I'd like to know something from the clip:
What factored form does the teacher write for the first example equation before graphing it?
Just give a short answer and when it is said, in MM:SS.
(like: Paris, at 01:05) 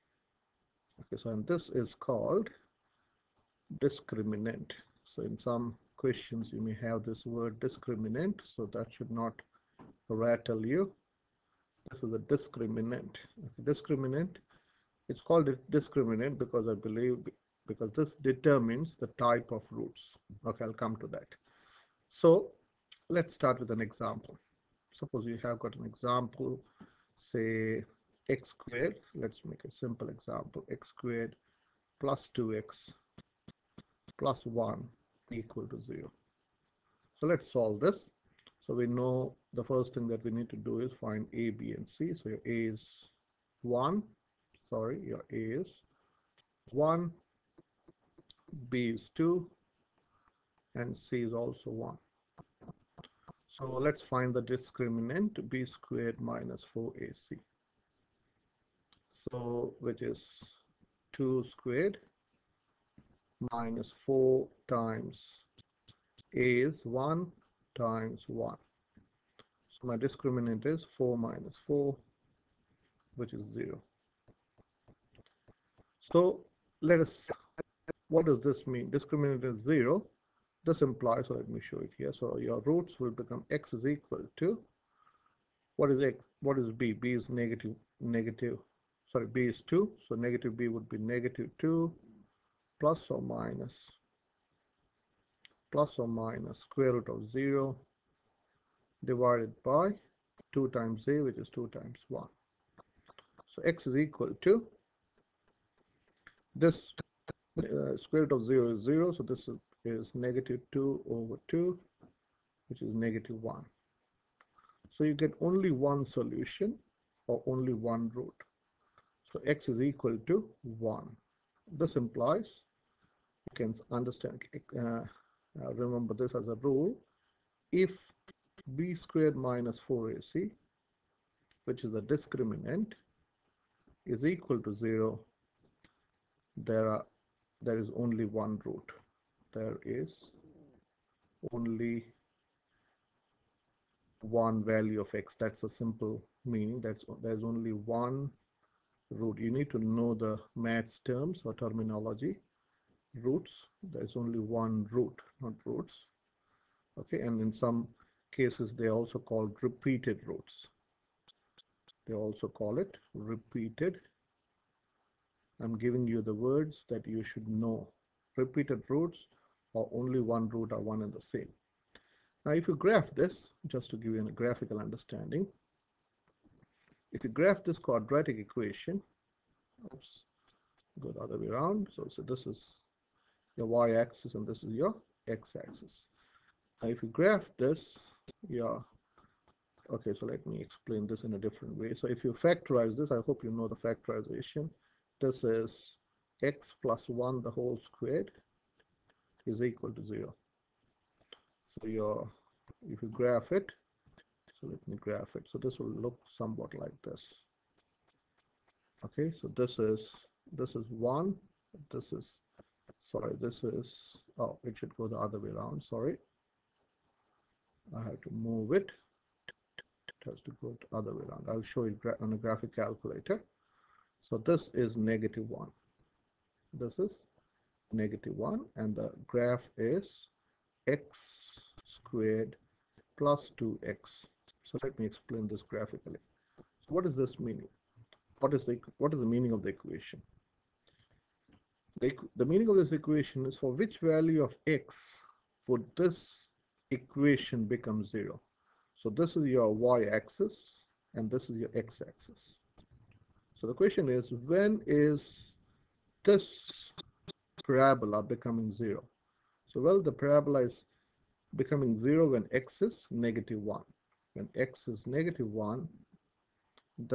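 (x + 1)^2 = 0, at 03:16.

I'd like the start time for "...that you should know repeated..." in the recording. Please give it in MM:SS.
02:46.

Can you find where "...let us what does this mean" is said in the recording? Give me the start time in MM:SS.
01:16.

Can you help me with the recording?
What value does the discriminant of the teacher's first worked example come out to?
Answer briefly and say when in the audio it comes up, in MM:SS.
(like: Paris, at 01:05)
0, at 01:10.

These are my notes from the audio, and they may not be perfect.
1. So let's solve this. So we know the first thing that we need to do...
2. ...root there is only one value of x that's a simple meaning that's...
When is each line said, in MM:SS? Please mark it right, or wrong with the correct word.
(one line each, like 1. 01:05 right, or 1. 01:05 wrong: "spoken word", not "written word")
1. 00:37 right
2. 02:18 right.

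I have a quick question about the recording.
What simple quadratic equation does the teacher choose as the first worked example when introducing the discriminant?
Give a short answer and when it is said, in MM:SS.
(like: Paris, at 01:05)
x^2 + 2x + 1 = 0, at 00:30.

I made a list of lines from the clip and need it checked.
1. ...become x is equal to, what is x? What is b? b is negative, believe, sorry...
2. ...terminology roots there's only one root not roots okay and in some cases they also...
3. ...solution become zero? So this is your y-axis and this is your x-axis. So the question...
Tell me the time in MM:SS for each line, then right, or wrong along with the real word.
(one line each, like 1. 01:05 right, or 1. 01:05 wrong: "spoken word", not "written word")
1. 01:23 wrong: "negative", not "believe"
2. 02:31 right
3. 04:06 wrong: "equation", not "solution".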